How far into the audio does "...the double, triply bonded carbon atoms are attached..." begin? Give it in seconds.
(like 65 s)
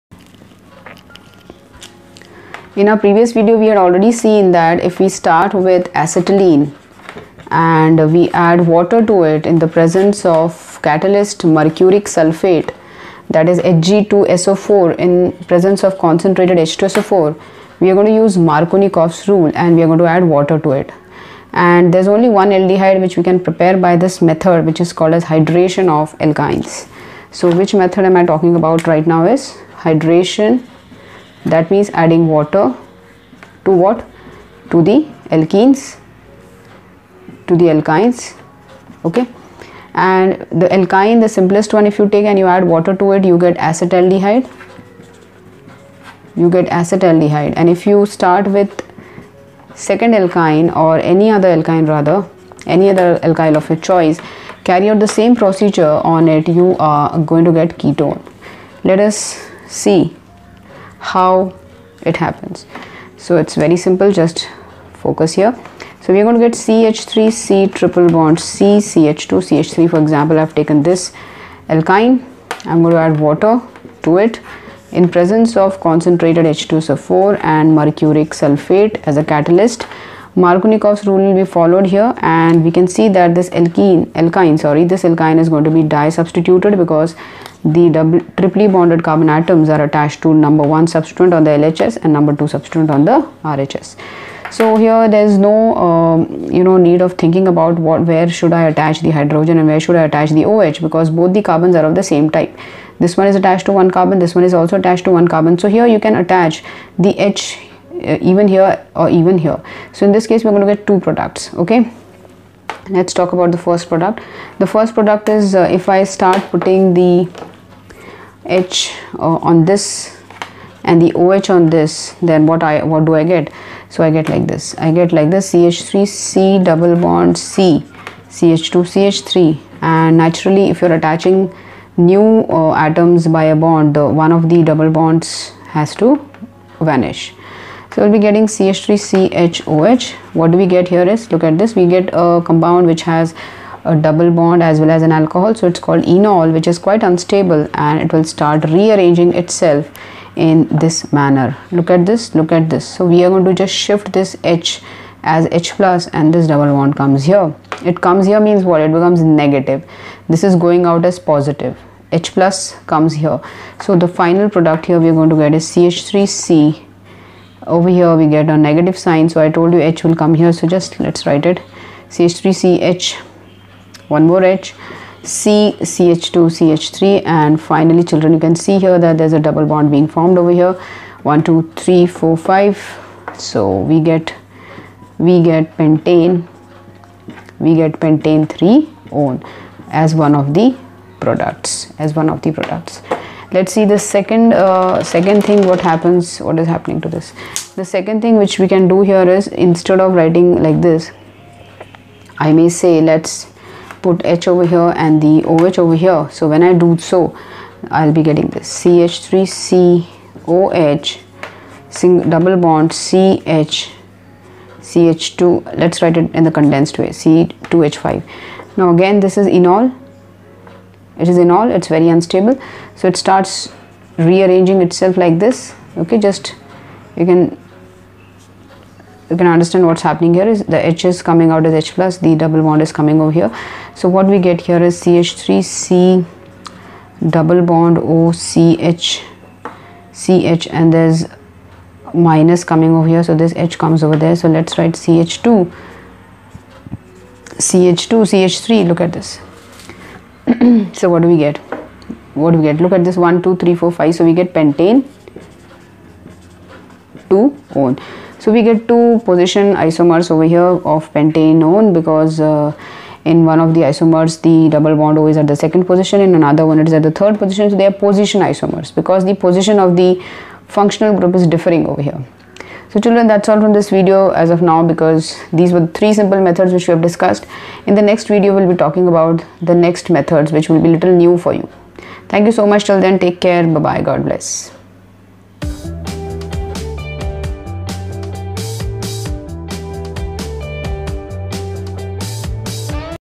87 s.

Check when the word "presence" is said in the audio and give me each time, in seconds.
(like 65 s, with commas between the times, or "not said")
9 s, 15 s, 75 s.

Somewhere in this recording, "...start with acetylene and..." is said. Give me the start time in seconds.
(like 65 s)
5 s.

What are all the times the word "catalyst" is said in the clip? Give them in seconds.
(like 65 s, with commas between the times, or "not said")
10 s, 79 s.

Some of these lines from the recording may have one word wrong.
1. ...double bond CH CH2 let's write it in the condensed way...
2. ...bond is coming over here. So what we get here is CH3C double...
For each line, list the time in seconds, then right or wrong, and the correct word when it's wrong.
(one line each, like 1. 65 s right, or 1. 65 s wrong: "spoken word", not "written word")
1. 212 s right
2. 232 s right.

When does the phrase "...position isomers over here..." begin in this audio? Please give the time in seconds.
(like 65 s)
259 s.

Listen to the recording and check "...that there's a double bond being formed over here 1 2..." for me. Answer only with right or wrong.
right.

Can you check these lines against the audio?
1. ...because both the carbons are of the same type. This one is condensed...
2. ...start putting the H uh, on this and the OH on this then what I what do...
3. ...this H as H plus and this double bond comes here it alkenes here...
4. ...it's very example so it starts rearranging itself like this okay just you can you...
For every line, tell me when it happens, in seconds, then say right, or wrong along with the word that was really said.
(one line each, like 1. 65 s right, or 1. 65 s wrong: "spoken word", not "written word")
1. 100 s wrong: "attached", not "condensed"
2. 116 s right
3. 154 s wrong: "comes", not "alkenes"
4. 221 s wrong: "unstable", not "example".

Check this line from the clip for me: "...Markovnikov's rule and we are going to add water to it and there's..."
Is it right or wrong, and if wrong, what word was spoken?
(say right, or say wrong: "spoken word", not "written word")
right.